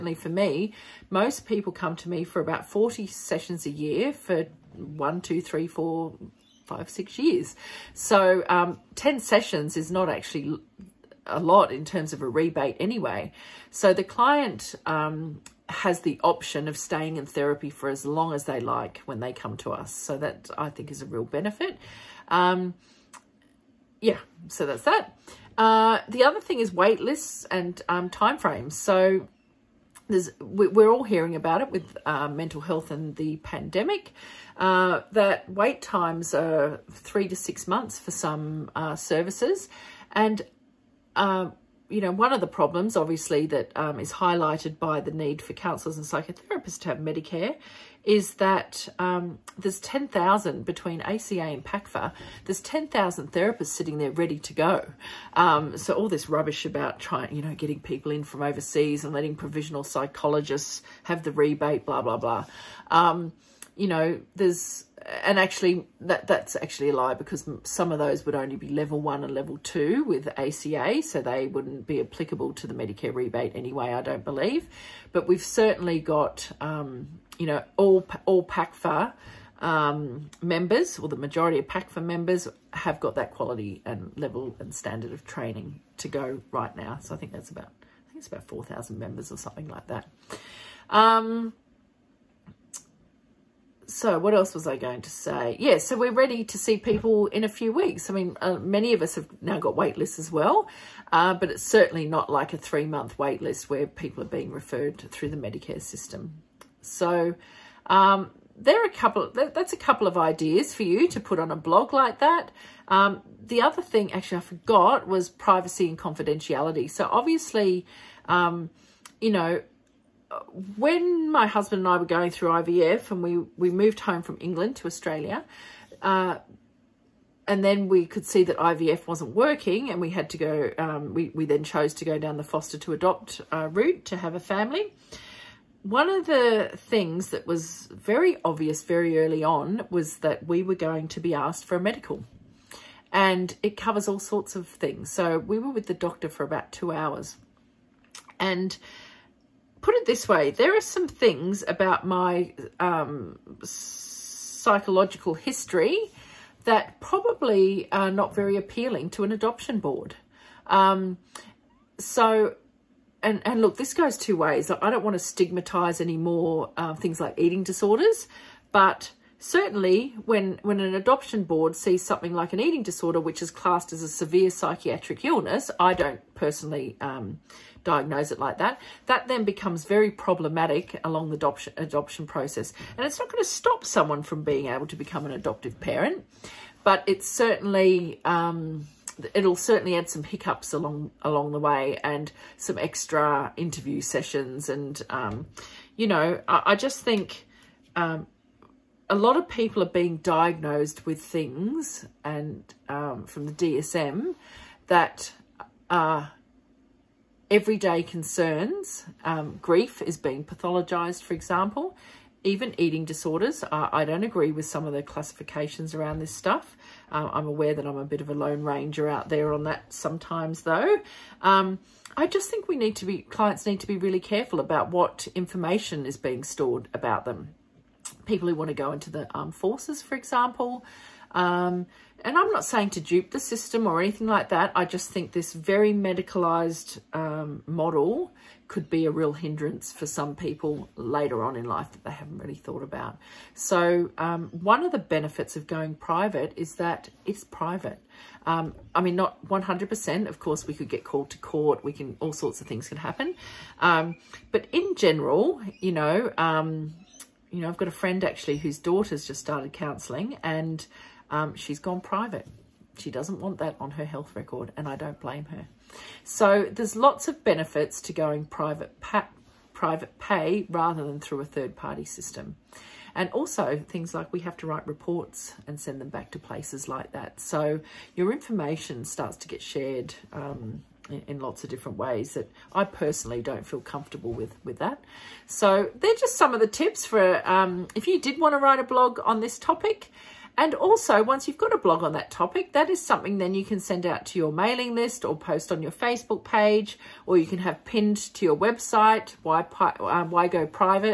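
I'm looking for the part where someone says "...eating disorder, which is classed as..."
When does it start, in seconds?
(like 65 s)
172 s.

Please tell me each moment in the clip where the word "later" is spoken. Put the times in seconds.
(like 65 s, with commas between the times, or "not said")
240 s.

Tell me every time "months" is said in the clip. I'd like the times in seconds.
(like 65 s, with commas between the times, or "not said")
37 s, 102 s.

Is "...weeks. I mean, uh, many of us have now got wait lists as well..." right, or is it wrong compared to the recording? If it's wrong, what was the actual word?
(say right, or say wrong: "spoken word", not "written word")
right.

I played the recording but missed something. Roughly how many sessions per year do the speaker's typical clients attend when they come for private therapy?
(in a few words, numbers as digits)
40.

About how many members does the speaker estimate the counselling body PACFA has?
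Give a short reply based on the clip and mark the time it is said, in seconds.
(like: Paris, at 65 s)
4,000, at 88 s.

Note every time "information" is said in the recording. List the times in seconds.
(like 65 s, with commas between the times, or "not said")
225 s, 278 s.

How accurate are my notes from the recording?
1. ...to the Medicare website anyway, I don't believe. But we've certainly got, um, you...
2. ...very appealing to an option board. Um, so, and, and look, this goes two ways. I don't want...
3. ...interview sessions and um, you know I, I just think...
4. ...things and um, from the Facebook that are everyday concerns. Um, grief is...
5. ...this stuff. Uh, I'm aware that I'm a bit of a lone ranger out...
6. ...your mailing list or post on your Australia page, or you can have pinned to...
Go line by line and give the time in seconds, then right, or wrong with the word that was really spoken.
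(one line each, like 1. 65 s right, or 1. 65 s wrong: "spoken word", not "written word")
1. 72 s wrong: "rebate", not "website"
2. 158 s wrong: "adoption", not "option"
3. 193 s right
4. 201 s wrong: "DSM", not "Facebook"
5. 216 s right
6. 294 s wrong: "Facebook", not "Australia".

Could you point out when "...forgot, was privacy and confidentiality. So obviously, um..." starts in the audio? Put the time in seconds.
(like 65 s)
114 s.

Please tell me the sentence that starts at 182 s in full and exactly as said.
And it's not going to stop someone from being able to become an adoptive parent, but it's certainly...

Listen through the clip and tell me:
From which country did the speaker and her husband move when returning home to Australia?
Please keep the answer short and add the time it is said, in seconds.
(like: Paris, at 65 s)
England, at 124 s.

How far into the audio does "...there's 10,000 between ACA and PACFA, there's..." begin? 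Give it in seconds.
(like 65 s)
49 s.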